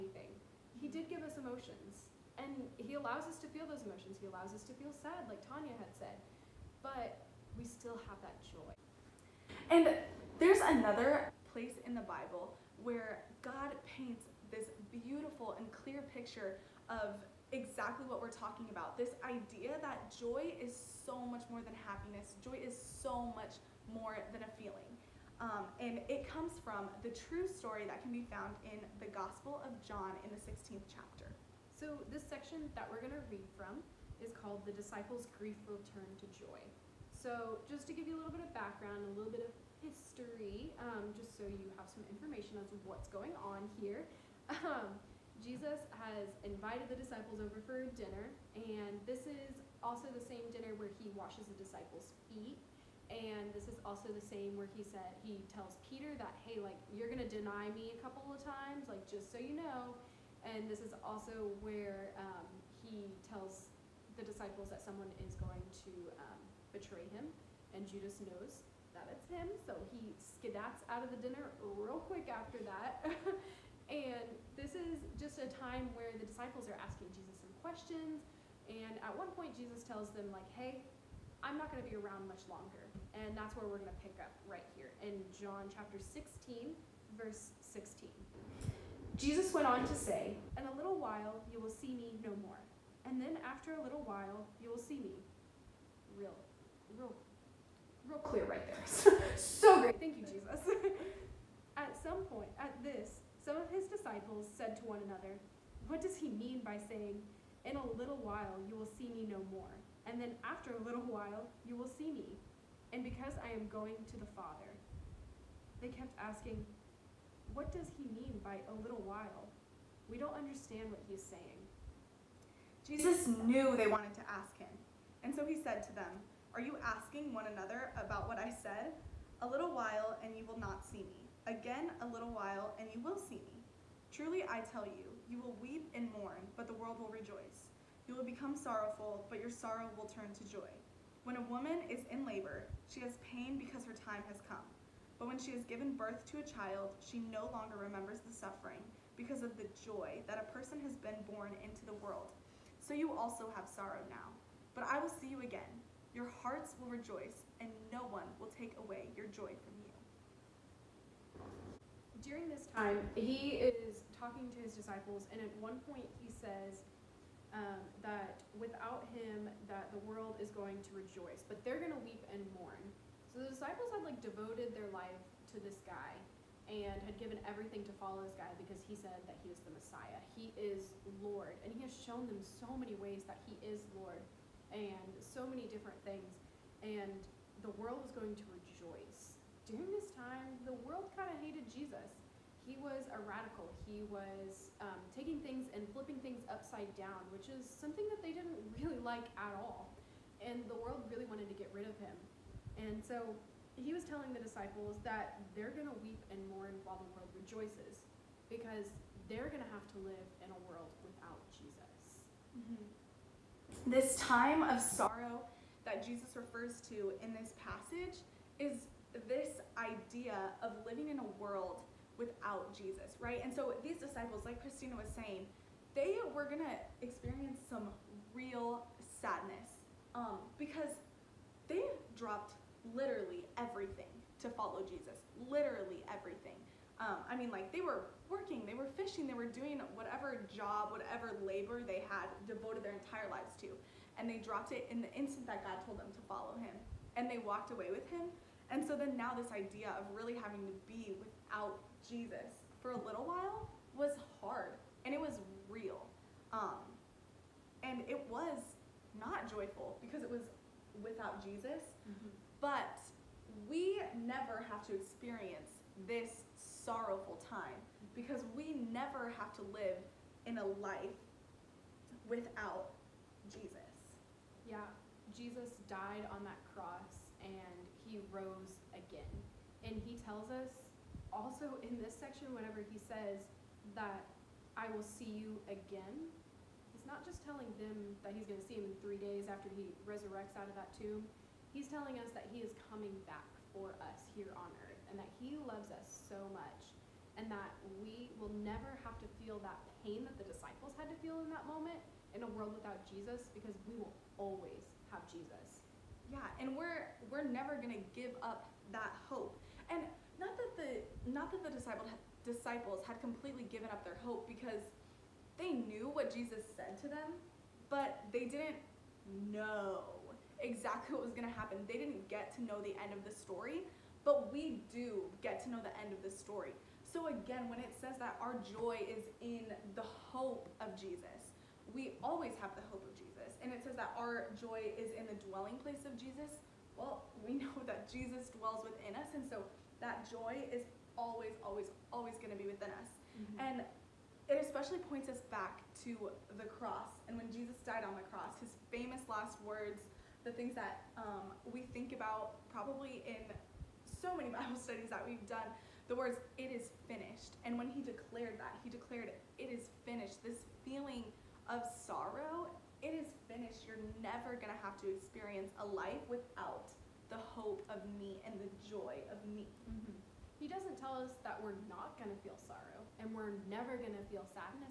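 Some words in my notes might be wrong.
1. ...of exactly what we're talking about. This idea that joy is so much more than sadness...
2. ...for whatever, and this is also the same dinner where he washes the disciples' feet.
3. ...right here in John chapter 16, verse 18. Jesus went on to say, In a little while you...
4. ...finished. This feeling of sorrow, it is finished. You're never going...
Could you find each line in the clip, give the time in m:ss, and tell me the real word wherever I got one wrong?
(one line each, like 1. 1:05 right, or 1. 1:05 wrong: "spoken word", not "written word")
1. 0:16 wrong: "happiness", not "sadness"
2. 0:47 wrong: "dinner", not "whatever"
3. 1:24 wrong: "16", not "18"
4. 6:00 right.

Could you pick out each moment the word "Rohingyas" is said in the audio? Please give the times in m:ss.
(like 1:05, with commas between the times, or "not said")
not said.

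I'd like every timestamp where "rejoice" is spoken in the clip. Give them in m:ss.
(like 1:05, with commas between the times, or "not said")
2:17, 2:36, 2:50, 3:08, 3:27.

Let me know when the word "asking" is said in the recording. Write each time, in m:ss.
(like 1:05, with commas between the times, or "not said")
1:16, 1:56, 2:06.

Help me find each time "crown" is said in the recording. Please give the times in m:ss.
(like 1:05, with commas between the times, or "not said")
not said.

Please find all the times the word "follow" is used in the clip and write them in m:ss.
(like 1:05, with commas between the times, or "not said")
2:57, 3:54, 4:06.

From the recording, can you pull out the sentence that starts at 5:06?
Yeah, and we're we're never going to give up that hope.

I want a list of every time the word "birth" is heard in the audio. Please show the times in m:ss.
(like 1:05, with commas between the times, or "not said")
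2:25.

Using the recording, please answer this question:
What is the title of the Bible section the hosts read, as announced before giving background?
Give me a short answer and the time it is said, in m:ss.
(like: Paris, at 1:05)
The Disciples' Grief Will Turn to Joy, at 0:34.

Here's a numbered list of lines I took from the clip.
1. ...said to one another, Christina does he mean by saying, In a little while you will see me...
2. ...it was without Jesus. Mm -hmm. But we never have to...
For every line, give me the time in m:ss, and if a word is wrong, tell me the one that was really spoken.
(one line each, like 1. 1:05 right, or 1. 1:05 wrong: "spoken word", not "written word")
1. 1:44 wrong: "What", not "Christina"
2. 4:20 right.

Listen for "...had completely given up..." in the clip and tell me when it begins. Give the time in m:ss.
5:13.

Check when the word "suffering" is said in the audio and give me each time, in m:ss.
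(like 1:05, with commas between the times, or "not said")
2:28.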